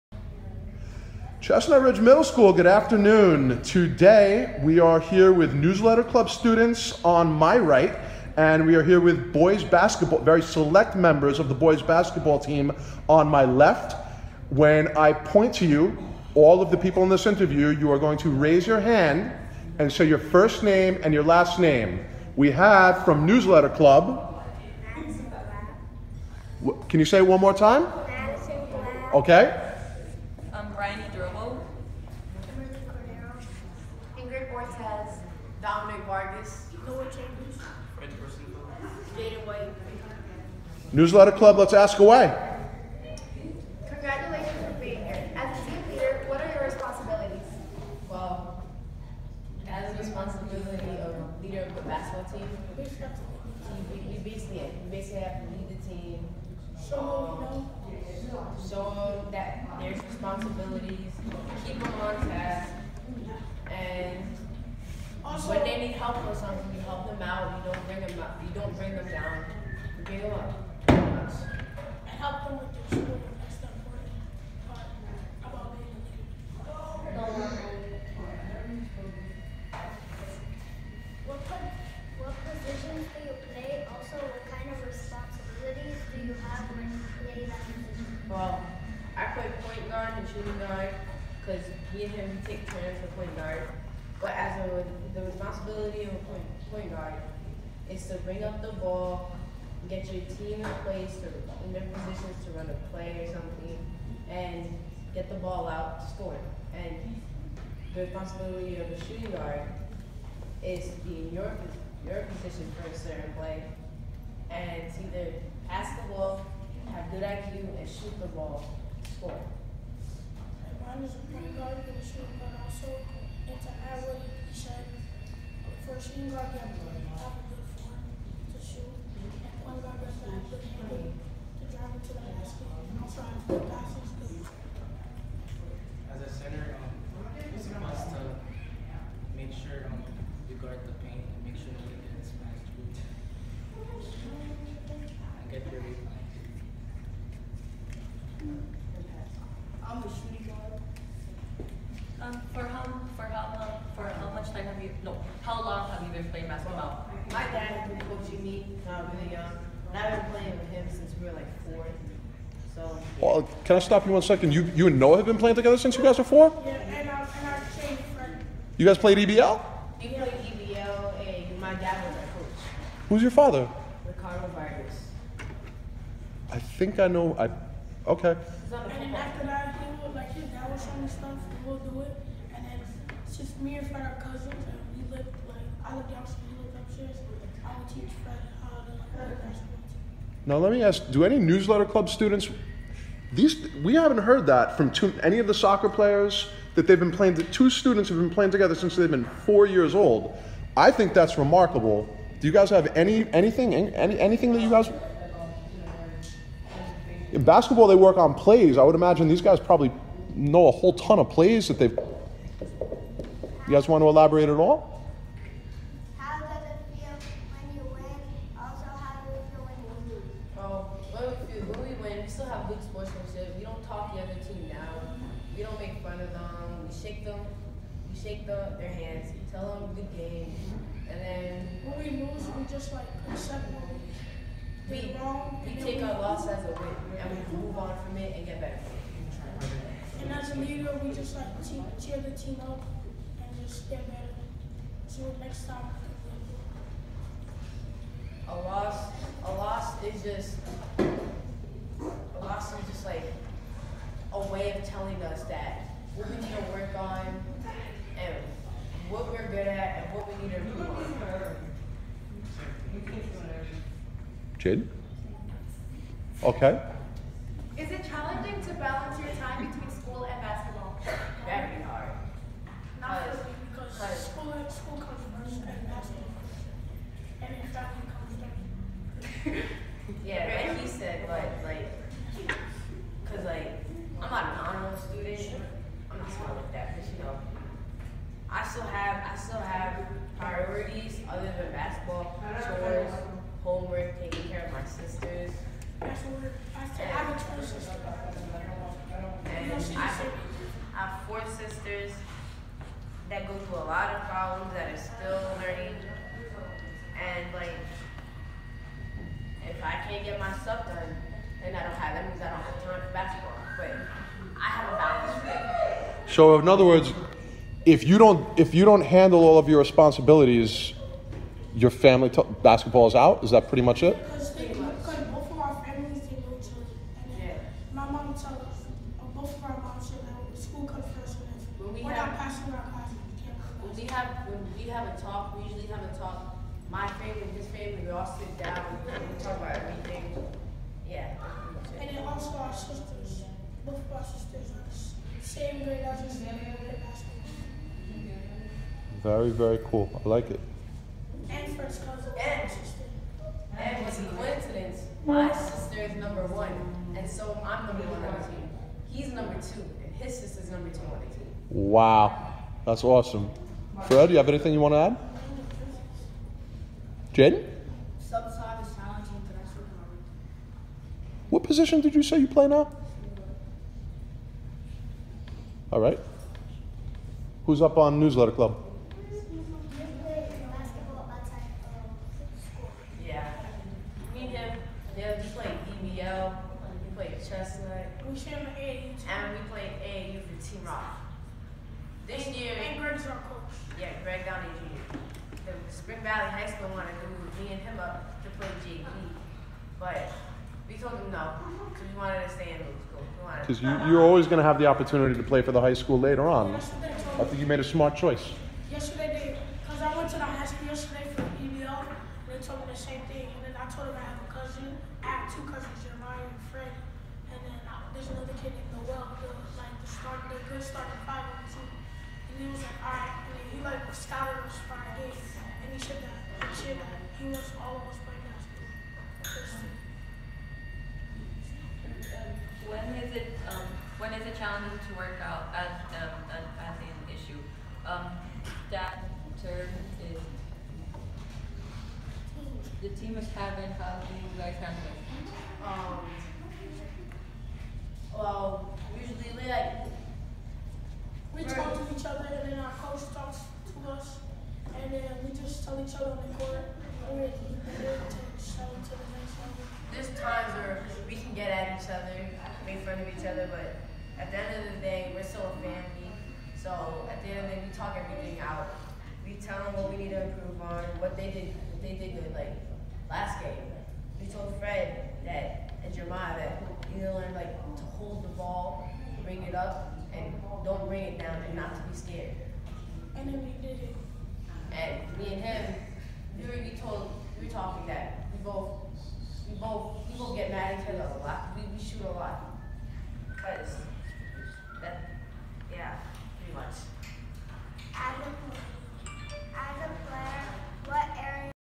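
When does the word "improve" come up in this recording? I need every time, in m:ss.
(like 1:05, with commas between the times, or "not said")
4:20, 7:50.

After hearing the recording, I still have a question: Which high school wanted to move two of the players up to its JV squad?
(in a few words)
Spring Valley High School.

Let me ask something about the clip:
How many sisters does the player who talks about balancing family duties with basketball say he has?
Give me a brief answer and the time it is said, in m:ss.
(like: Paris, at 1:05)
4, at 5:01.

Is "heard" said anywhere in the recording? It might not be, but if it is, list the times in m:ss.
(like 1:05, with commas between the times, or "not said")
3:14.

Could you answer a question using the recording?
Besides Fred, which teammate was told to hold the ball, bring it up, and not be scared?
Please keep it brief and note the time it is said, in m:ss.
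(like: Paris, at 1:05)
Jeremiah, at 7:56.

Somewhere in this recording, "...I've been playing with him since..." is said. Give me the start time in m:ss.
2:39.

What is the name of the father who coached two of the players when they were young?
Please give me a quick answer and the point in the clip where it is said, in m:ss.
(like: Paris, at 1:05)
Ricardo Vargas, at 2:54.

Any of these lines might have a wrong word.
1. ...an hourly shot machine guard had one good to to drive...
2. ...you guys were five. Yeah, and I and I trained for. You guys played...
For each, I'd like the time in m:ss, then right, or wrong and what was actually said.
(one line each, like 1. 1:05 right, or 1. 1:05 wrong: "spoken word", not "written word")
1. 2:03 right
2. 2:45 wrong: "four", not "five".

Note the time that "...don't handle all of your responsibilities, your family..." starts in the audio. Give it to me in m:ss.
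5:18.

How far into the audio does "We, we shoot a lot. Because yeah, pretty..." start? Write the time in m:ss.
8:11.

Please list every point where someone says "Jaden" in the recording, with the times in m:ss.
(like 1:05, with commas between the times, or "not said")
0:39, 6:07.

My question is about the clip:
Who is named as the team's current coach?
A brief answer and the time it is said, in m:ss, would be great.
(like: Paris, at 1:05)
Greg Downey Jr., at 6:34.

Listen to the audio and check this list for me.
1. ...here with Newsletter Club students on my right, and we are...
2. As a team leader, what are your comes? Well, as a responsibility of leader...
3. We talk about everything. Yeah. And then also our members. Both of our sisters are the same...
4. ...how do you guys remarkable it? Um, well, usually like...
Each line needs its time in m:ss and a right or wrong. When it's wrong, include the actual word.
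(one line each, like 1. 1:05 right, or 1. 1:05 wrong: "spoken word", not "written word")
1. 0:04 right
2. 0:45 wrong: "responsibilities", not "comes"
3. 5:39 wrong: "sisters", not "members"
4. 7:23 wrong: "handle", not "remarkable".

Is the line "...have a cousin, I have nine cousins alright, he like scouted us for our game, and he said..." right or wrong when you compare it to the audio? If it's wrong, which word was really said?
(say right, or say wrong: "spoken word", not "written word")
wrong: "two", not "nine".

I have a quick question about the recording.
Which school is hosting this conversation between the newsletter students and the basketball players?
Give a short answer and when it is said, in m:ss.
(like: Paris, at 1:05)
Chestnut Ridge Middle School, at 0:01.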